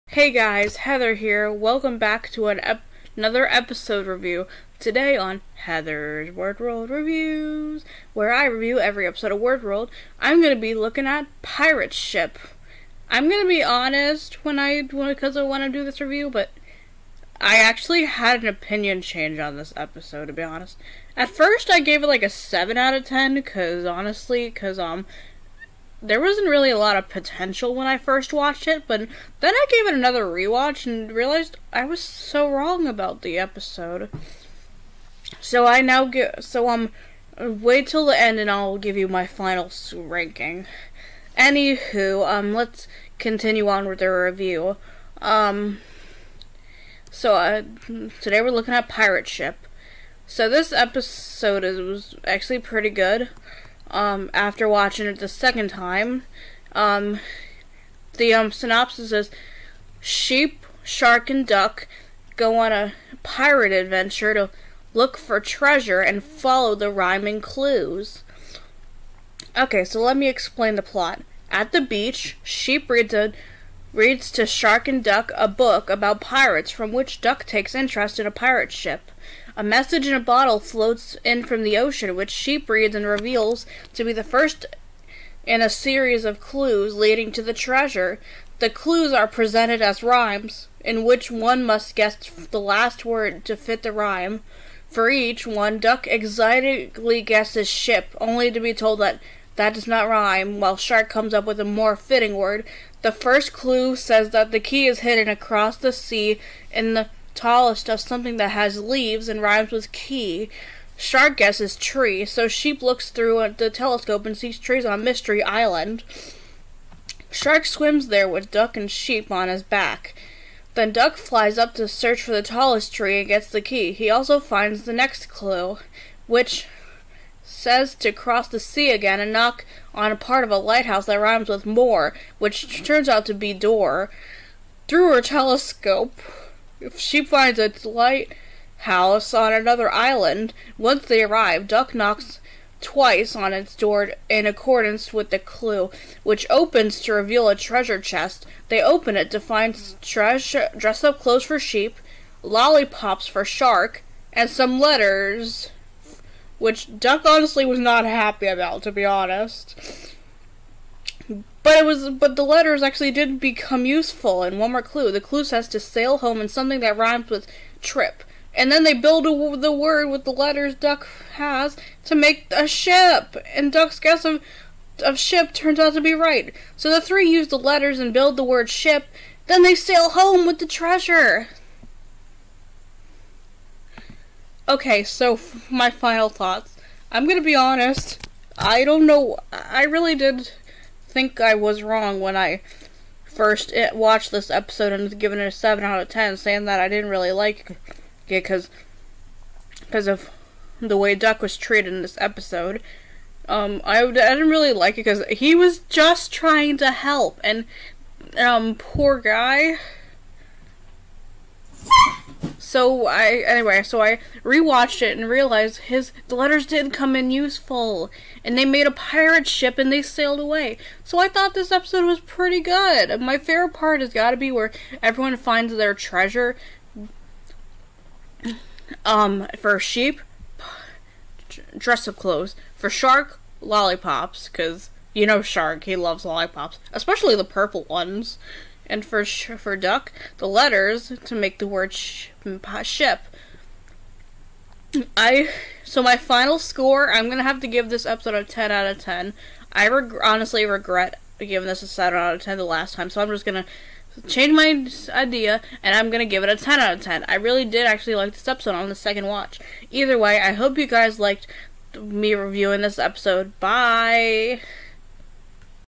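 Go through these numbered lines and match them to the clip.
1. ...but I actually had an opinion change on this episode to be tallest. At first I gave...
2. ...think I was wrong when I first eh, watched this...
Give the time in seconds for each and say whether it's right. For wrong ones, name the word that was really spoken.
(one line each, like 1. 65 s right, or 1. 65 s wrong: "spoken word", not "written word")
1. 16 s wrong: "honest", not "tallest"
2. 191 s right.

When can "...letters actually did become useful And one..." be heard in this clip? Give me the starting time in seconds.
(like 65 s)
162 s.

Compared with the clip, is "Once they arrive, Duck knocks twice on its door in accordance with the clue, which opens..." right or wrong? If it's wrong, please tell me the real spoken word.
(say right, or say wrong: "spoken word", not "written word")
right.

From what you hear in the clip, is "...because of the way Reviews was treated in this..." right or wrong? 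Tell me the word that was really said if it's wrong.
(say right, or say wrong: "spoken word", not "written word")
wrong: "Duck", not "Reviews".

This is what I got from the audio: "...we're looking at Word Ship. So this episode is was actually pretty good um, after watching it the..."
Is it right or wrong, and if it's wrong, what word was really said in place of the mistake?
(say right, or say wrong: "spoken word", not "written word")
wrong: "Pirate", not "Word".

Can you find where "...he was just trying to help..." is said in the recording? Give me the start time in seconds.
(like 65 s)
205 s.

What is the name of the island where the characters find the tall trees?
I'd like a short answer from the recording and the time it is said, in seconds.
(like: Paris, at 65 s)
Mystery Island, at 115 s.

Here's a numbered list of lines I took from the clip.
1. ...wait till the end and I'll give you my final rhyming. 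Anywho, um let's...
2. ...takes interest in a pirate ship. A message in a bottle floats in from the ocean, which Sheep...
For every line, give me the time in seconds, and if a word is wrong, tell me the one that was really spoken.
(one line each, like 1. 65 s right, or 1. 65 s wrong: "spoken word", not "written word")
1. 37 s wrong: "ranking", not "rhyming"
2. 77 s right.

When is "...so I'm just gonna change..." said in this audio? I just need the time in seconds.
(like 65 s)
253 s.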